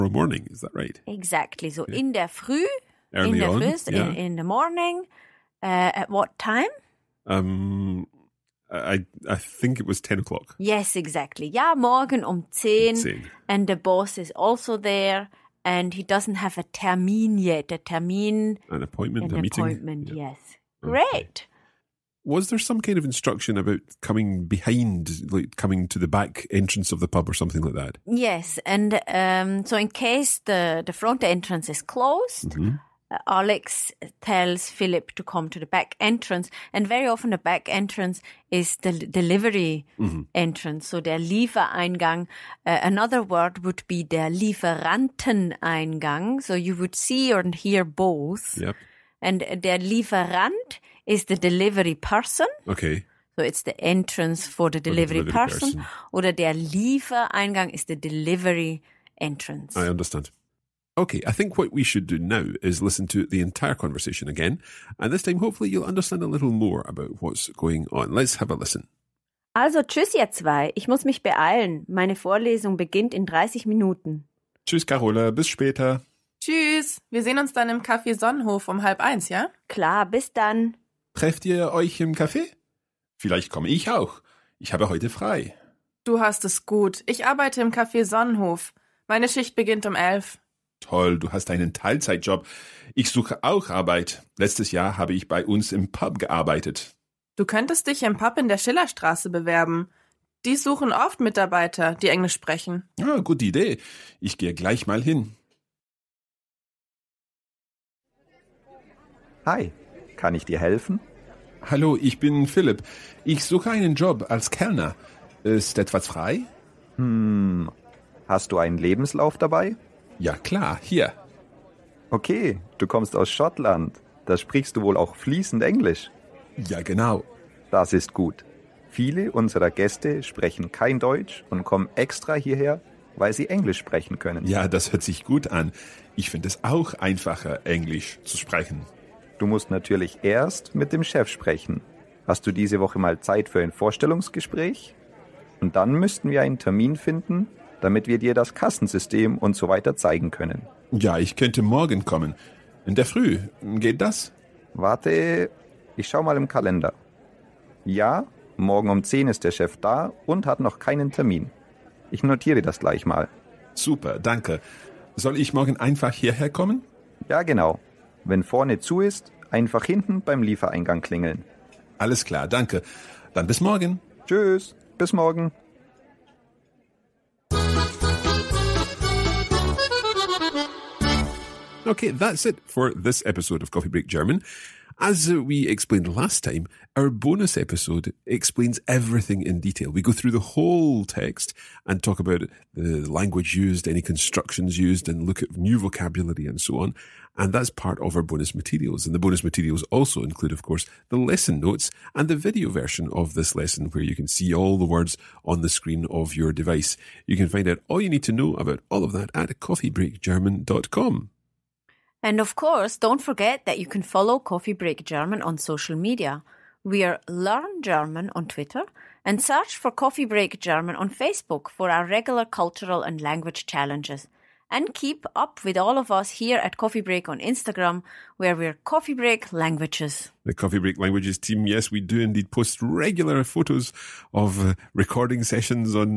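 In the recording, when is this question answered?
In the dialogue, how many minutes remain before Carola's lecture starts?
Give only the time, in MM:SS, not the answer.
01:13.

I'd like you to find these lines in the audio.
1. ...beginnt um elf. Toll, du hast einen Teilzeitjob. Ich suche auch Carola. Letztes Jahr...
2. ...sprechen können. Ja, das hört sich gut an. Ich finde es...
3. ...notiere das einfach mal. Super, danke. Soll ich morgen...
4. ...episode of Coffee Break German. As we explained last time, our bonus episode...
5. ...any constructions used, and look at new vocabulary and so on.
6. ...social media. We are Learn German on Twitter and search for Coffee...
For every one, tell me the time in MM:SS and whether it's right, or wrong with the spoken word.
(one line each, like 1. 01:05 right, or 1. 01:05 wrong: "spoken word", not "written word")
1. 01:29 wrong: "Arbeit", not "Carola"
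2. 02:13 right
3. 02:42 wrong: "gleich", not "einfach"
4. 03:03 right
5. 03:13 right
6. 03:35 right.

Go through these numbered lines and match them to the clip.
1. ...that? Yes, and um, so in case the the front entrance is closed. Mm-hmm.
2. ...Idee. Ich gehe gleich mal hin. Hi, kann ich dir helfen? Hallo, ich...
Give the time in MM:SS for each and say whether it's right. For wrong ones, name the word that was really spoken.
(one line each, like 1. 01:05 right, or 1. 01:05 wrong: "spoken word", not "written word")
1. 00:27 right
2. 01:43 right.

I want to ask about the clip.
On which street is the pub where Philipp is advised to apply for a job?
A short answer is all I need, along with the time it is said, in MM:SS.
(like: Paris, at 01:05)
Schillerstraße, at 01:38.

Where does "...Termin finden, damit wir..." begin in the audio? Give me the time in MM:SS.
02:26.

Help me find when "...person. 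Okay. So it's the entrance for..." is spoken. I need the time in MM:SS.
00:51.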